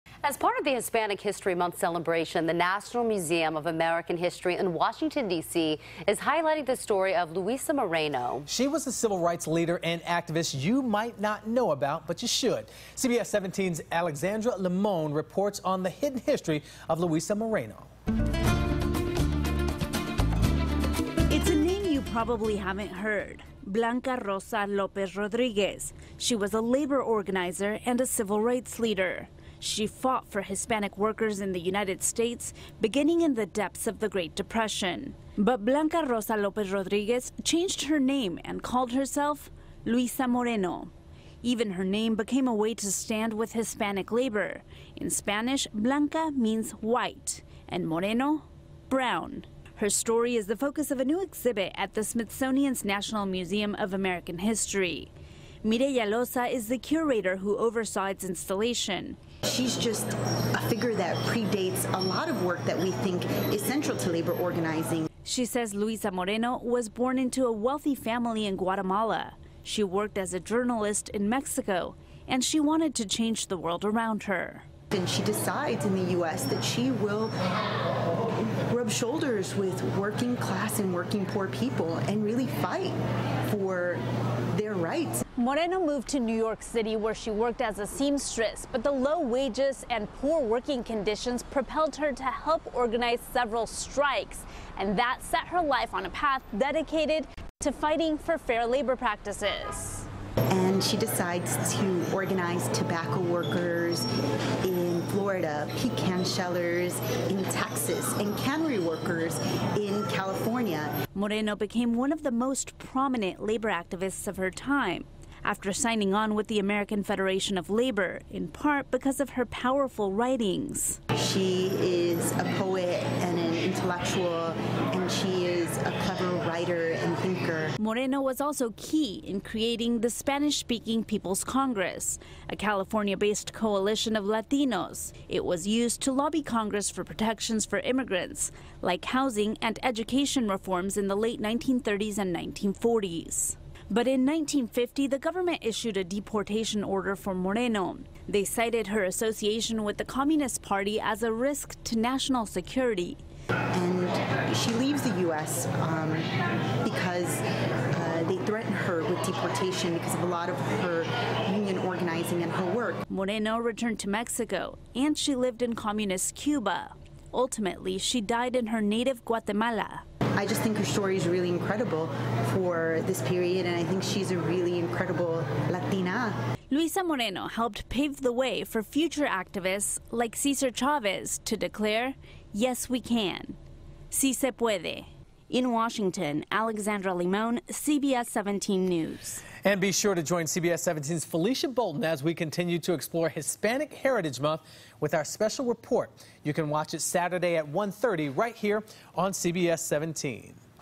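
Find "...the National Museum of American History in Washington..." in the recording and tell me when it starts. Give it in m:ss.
0:02.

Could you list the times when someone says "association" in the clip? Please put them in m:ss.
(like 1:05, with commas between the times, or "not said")
2:29.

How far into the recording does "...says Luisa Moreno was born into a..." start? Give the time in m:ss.
1:05.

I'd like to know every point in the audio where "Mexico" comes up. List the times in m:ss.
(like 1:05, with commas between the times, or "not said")
1:11, 2:44.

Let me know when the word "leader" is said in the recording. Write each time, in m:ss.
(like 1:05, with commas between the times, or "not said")
0:09, 0:28.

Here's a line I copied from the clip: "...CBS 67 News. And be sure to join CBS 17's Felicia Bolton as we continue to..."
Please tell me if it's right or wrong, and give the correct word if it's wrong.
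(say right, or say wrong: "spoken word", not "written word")
wrong: "17", not "67".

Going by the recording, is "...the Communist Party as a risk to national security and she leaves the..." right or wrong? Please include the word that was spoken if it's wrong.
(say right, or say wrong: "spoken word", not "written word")
right.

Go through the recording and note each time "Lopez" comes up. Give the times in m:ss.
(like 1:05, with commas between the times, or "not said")
0:24, 0:36.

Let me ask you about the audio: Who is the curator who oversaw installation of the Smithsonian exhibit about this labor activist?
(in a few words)
Mireya Loza.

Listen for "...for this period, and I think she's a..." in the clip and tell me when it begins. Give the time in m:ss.
2:52.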